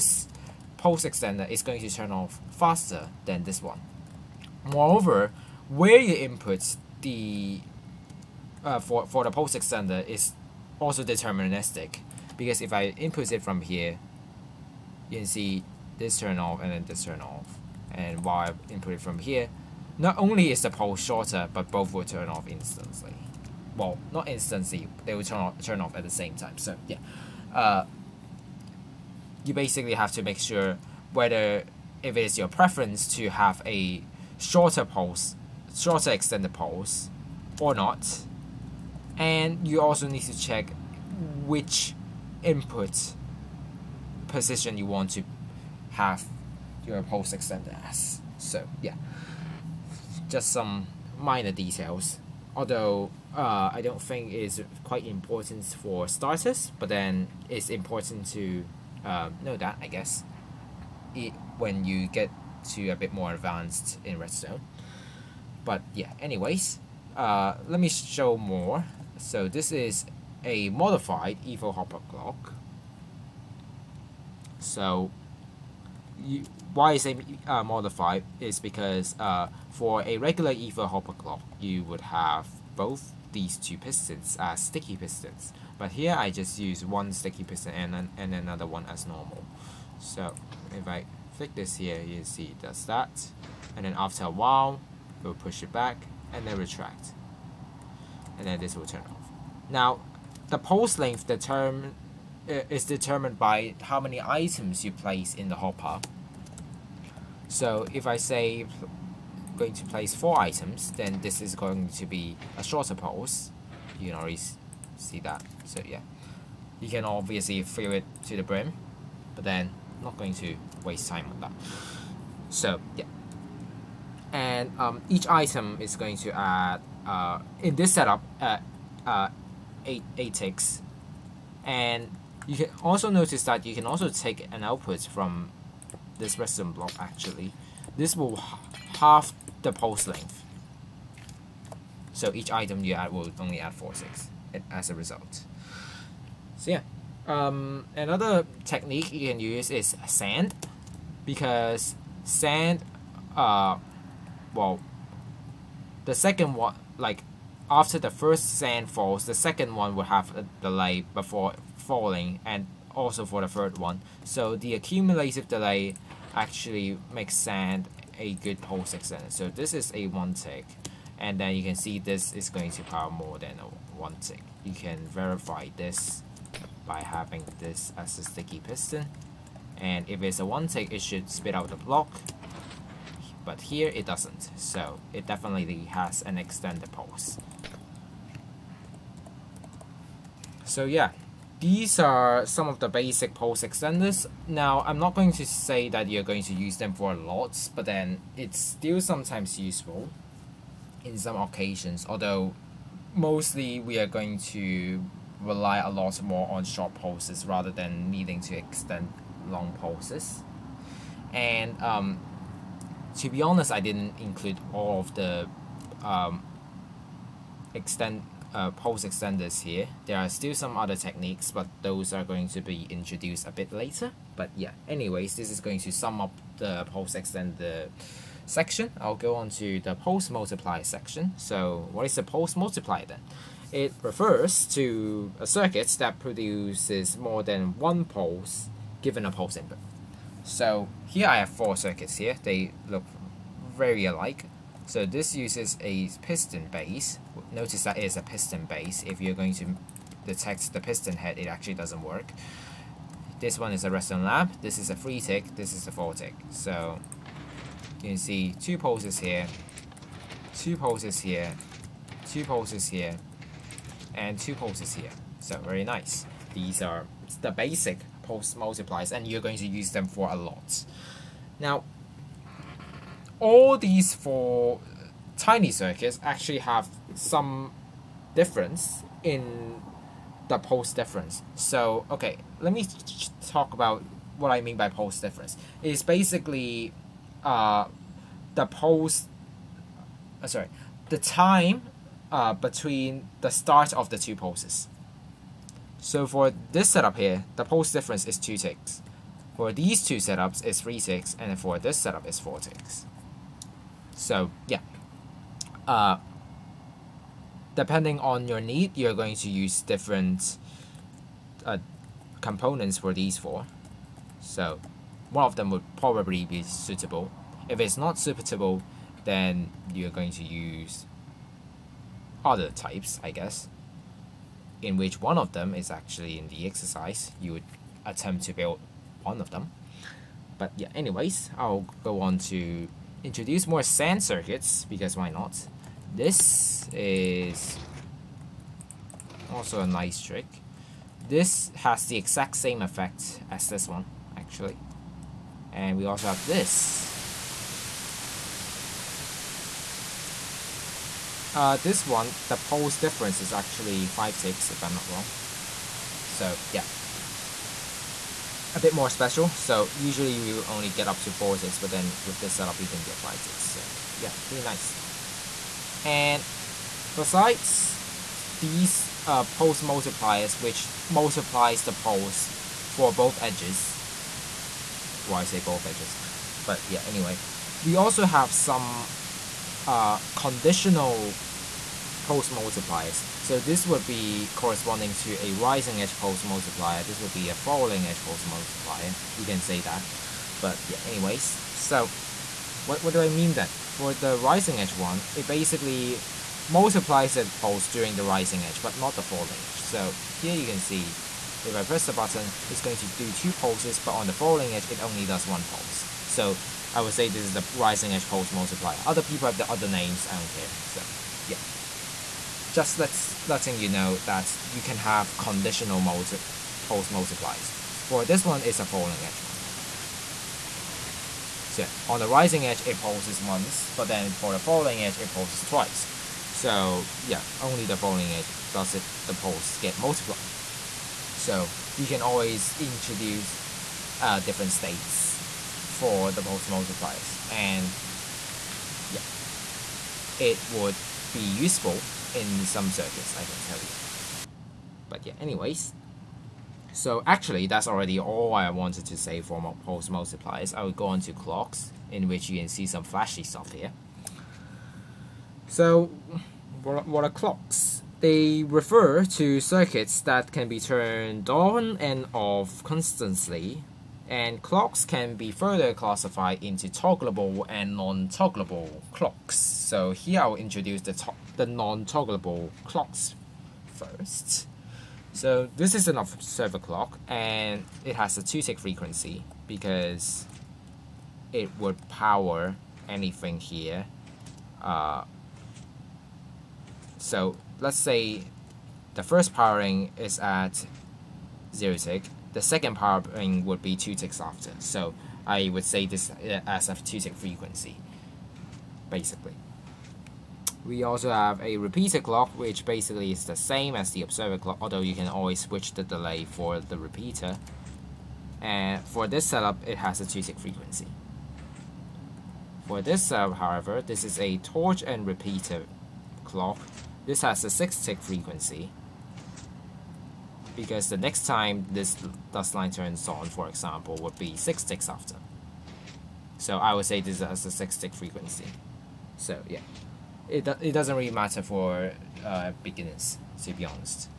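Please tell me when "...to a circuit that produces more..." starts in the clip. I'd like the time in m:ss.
3:54.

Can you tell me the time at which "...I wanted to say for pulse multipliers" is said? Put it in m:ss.
7:28.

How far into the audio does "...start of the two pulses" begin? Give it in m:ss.
4:53.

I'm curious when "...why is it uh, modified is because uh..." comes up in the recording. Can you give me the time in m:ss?
1:16.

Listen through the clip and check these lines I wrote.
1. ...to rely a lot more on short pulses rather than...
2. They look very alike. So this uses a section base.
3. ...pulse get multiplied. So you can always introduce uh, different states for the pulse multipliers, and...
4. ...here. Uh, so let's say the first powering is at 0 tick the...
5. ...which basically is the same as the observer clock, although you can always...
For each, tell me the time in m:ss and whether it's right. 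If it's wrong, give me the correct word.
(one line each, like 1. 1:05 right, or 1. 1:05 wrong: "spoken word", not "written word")
1. 3:24 right
2. 4:02 wrong: "piston", not "section"
3. 7:09 right
4. 8:03 right
5. 8:22 right.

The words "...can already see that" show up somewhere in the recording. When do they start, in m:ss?
1:54.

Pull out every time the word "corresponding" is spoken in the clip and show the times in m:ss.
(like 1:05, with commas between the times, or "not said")
6:24.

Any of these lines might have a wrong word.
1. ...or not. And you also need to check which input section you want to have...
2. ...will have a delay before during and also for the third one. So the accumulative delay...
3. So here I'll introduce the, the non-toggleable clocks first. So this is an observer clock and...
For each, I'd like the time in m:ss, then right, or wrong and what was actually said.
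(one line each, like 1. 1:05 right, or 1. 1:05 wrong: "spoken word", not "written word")
1. 0:37 wrong: "position", not "section"
2. 2:39 wrong: "falling", not "during"
3. 7:49 right.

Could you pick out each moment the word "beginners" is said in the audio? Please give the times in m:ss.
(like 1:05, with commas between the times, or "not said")
8:52.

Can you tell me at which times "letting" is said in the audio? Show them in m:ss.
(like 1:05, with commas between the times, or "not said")
6:53.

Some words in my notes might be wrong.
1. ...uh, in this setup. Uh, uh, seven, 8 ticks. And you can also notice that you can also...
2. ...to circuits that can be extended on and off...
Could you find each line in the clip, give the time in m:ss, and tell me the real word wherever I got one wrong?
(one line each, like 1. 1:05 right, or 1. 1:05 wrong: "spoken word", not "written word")
1. 2:07 wrong: "eight", not "seven"
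2. 7:39 wrong: "turned", not "extended".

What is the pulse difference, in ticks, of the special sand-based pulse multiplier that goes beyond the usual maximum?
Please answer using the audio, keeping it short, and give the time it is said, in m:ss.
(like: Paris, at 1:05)
5, at 5:54.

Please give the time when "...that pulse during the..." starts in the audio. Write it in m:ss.
6:37.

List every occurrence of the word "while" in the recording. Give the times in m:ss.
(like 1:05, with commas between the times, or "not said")
0:18, 1:34.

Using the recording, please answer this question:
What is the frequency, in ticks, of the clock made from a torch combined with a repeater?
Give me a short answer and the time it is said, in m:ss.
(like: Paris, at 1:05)
6, at 8:37.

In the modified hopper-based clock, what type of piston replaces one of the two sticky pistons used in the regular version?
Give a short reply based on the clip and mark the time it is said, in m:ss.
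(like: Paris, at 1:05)
Normal, at 1:29.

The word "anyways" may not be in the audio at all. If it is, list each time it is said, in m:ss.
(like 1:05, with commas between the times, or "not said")
1:06, 3:44, 5:30, 6:17, 6:31, 7:25.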